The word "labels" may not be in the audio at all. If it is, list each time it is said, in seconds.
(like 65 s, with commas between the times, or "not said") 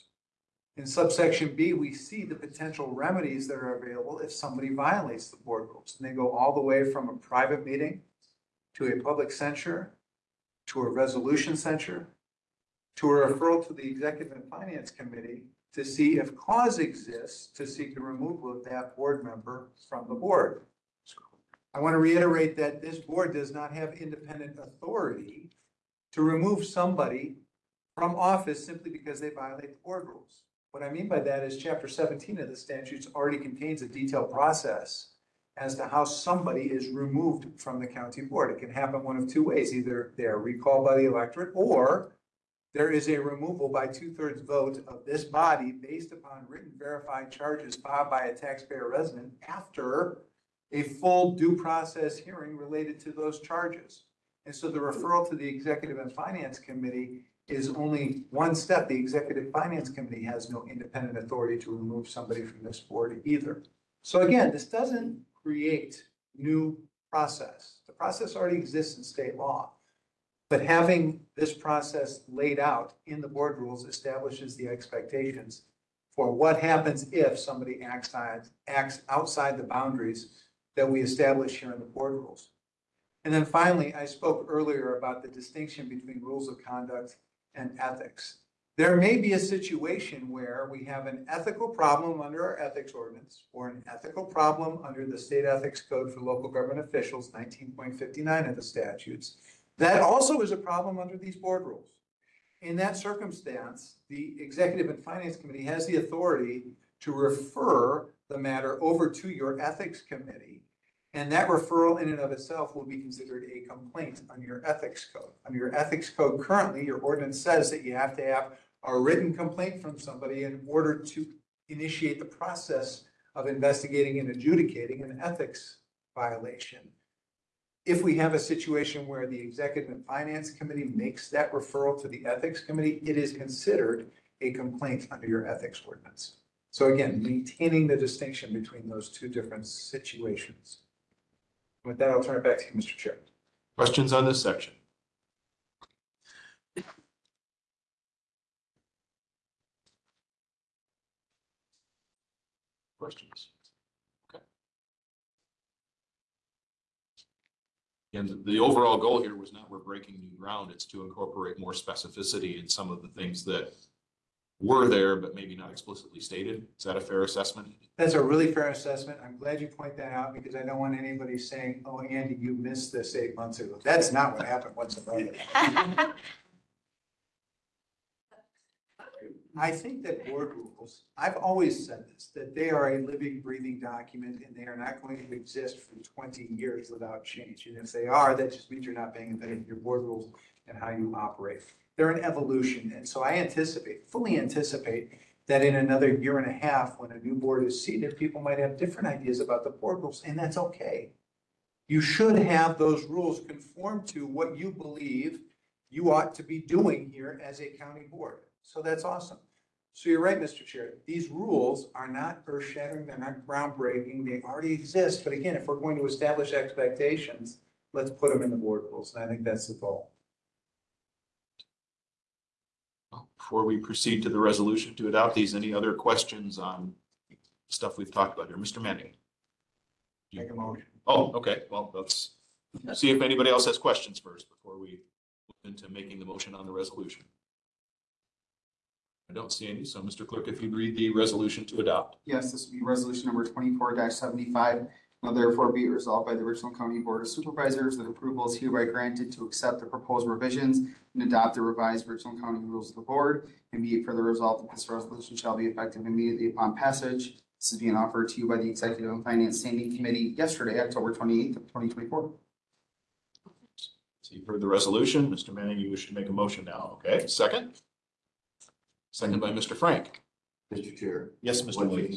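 not said.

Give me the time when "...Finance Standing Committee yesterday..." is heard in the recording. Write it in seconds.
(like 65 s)
259 s.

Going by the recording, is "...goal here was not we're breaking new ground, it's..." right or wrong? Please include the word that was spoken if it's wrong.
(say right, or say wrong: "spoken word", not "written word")
right.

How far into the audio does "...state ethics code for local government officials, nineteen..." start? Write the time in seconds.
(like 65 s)
95 s.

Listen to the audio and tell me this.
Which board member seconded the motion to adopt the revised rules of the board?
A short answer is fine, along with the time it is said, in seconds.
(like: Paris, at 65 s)
Mr. Frank, at 269 s.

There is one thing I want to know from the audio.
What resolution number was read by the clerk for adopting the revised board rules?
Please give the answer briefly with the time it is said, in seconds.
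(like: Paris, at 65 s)
24-75, at 243 s.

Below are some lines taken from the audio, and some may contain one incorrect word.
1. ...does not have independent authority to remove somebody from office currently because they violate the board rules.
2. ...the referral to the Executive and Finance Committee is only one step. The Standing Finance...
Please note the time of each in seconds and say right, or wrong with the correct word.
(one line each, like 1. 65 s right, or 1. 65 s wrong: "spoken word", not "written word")
1. 23 s wrong: "simply", not "currently"
2. 54 s wrong: "Executive", not "Standing".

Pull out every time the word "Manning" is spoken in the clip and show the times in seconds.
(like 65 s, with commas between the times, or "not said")
228 s, 265 s.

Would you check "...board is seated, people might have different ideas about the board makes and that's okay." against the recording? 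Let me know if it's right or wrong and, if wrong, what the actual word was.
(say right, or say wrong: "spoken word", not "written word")
wrong: "rules", not "makes".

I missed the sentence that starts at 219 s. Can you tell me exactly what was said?
And I think that's the goal.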